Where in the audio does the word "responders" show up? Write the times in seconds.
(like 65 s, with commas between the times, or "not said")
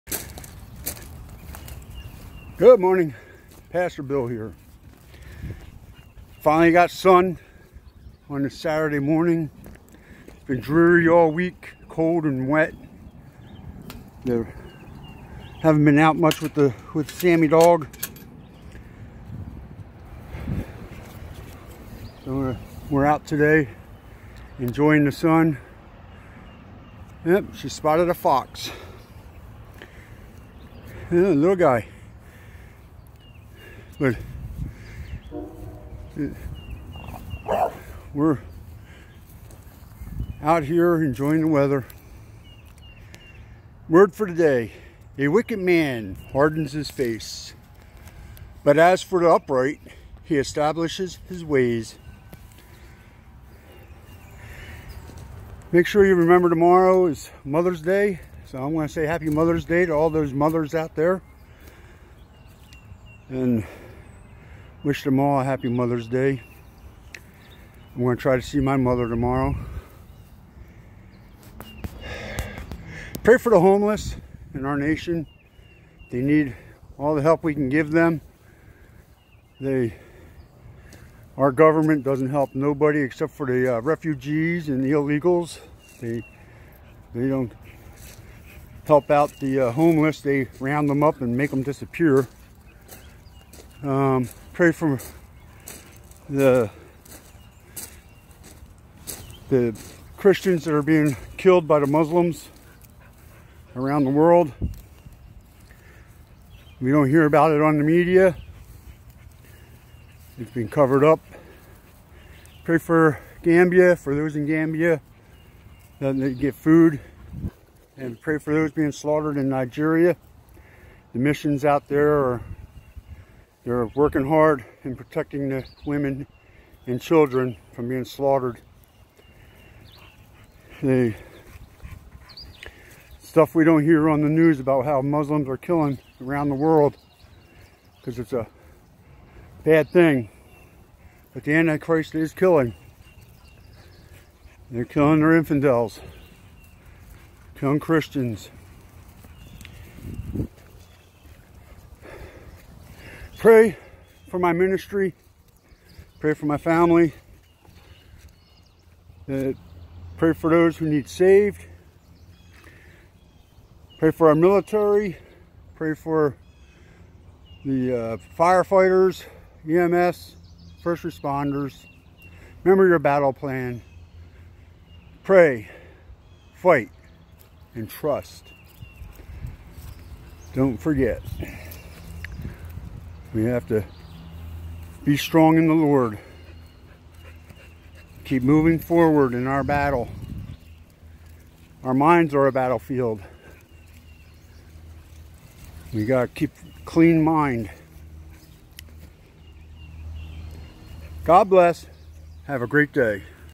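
171 s.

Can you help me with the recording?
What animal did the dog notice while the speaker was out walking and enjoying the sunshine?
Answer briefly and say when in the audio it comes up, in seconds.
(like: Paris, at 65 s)
fox, at 28 s.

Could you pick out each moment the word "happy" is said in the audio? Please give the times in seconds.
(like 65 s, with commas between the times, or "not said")
59 s, 65 s.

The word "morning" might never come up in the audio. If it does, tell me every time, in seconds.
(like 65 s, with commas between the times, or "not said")
2 s, 8 s.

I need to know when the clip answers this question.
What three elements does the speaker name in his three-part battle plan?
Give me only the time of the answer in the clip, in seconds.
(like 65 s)
175 s.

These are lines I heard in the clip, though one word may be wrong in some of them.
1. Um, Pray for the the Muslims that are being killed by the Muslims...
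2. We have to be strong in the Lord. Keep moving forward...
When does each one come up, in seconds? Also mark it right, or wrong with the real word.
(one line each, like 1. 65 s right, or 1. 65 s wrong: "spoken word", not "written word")
1. 93 s wrong: "Christians", not "Muslims"
2. 183 s right.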